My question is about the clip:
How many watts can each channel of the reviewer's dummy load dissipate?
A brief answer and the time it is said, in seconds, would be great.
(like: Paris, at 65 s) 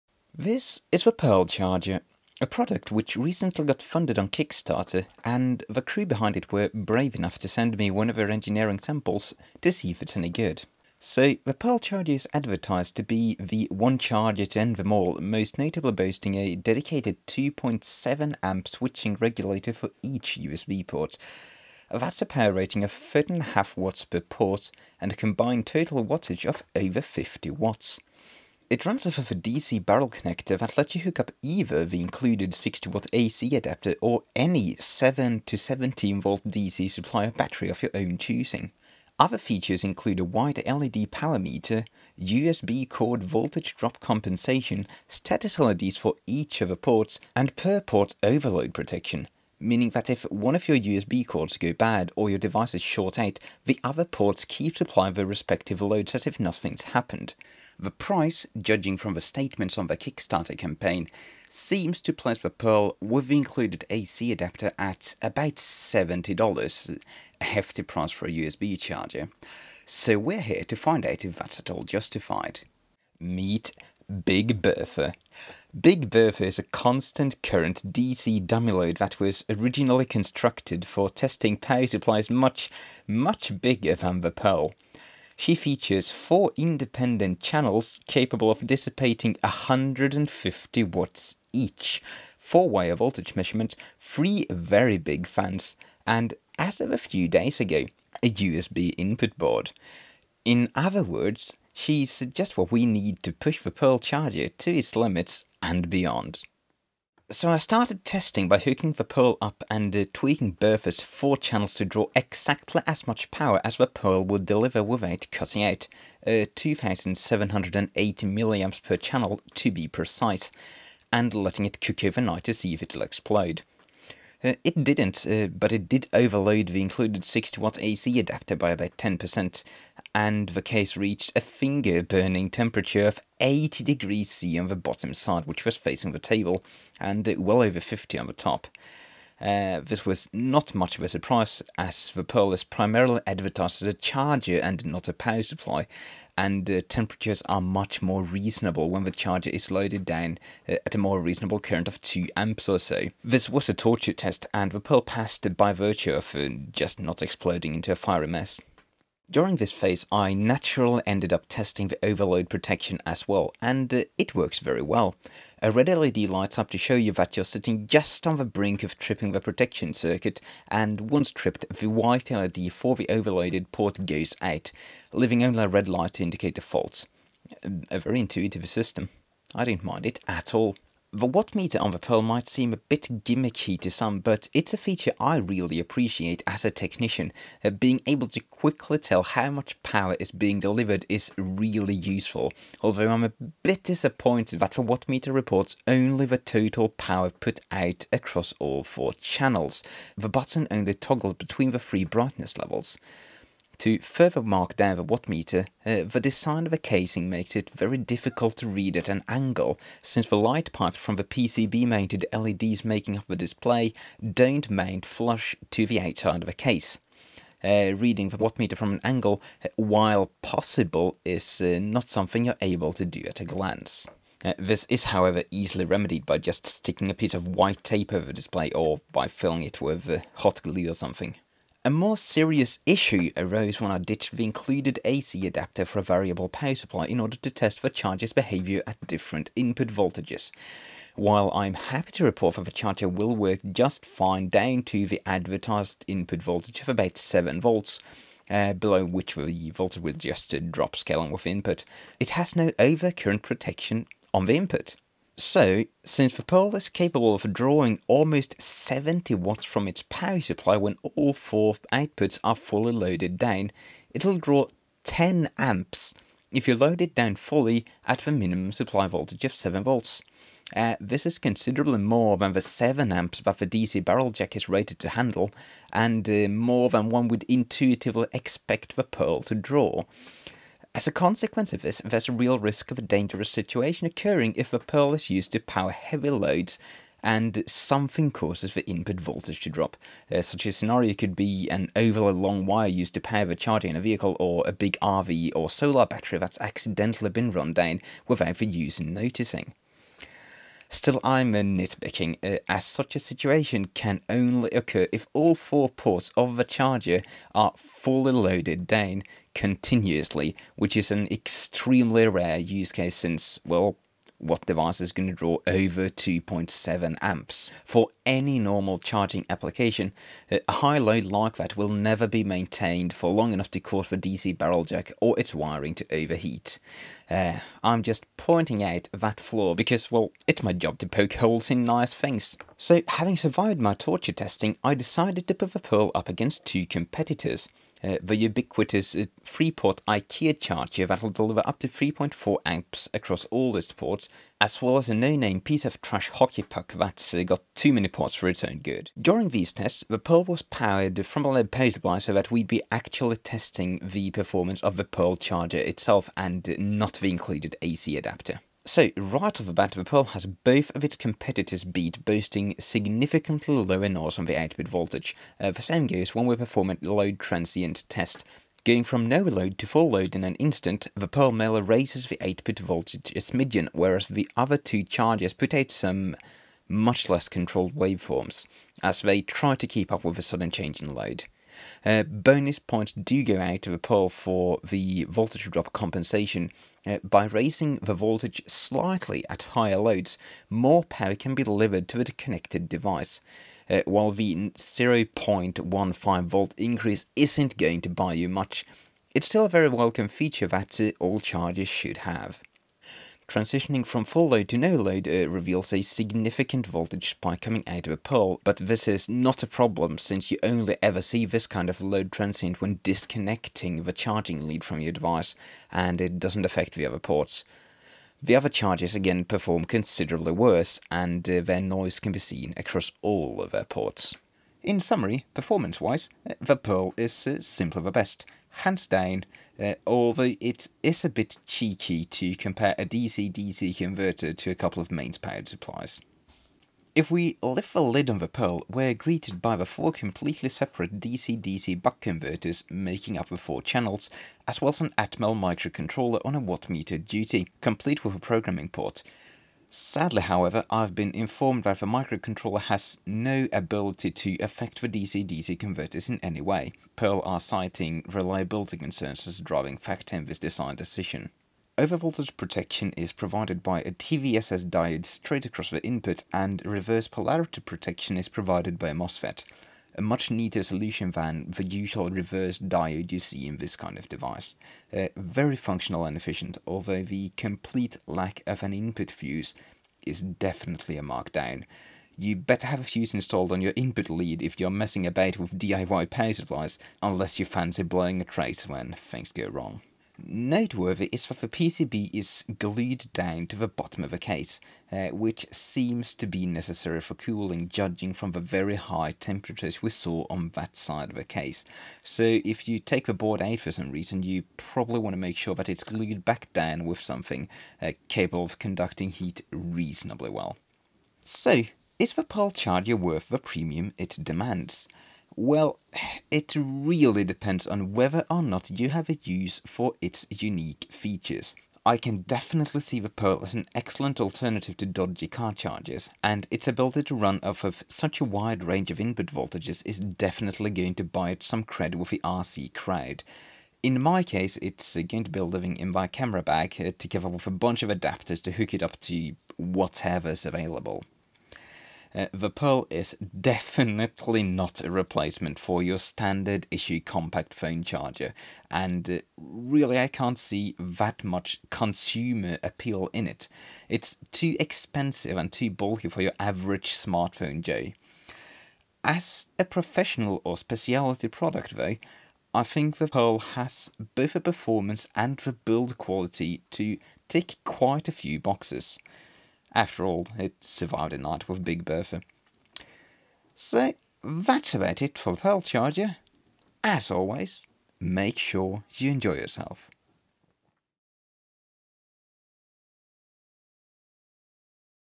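150 watts, at 89 s.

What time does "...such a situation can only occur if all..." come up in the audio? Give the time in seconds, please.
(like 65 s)
302 s.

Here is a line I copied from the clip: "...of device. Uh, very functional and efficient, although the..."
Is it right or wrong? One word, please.
right.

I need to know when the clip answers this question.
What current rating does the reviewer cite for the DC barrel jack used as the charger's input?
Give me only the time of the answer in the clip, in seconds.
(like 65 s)
272 s.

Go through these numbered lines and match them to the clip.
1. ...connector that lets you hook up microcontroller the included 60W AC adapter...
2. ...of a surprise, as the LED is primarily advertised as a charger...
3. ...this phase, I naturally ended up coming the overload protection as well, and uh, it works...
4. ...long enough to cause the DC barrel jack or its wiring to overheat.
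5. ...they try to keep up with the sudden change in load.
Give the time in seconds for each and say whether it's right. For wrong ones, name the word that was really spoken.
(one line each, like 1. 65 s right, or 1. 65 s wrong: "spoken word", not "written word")
1. 30 s wrong: "either", not "microcontroller"
2. 140 s wrong: "Pirl", not "LED"
3. 159 s wrong: "testing", not "coming"
4. 323 s right
5. 379 s right.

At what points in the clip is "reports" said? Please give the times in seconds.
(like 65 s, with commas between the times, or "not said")
195 s, 242 s.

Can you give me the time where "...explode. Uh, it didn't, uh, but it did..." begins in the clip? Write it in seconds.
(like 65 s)
123 s.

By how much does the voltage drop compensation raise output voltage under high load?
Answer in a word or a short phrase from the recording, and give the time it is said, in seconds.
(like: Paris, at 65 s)
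0.15 volt, at 394 s.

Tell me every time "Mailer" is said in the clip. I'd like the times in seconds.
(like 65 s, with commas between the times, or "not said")
371 s.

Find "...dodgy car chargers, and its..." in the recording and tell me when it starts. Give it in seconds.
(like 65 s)
525 s.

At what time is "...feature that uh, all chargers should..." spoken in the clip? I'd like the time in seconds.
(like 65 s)
400 s.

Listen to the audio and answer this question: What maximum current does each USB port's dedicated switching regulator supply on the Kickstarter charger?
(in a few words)
2.7 amps.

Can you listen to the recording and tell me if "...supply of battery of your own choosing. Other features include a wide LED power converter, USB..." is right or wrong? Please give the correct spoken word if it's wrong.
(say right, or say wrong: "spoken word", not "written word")
wrong: "meter", not "converter".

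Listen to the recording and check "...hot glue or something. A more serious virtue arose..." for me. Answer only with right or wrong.
wrong.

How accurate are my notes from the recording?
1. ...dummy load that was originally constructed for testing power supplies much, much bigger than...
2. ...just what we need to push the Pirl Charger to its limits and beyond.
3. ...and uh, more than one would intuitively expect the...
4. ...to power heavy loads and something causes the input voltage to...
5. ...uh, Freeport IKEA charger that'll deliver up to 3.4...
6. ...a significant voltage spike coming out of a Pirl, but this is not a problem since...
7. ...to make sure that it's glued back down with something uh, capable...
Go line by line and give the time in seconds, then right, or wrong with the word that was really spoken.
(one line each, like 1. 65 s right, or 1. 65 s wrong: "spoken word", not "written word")
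1. 78 s right
2. 102 s right
3. 275 s right
4. 285 s right
5. 339 s right
6. 405 s right
7. 505 s right.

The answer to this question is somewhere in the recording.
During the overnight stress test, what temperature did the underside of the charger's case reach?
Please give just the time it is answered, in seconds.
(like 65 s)
133 s.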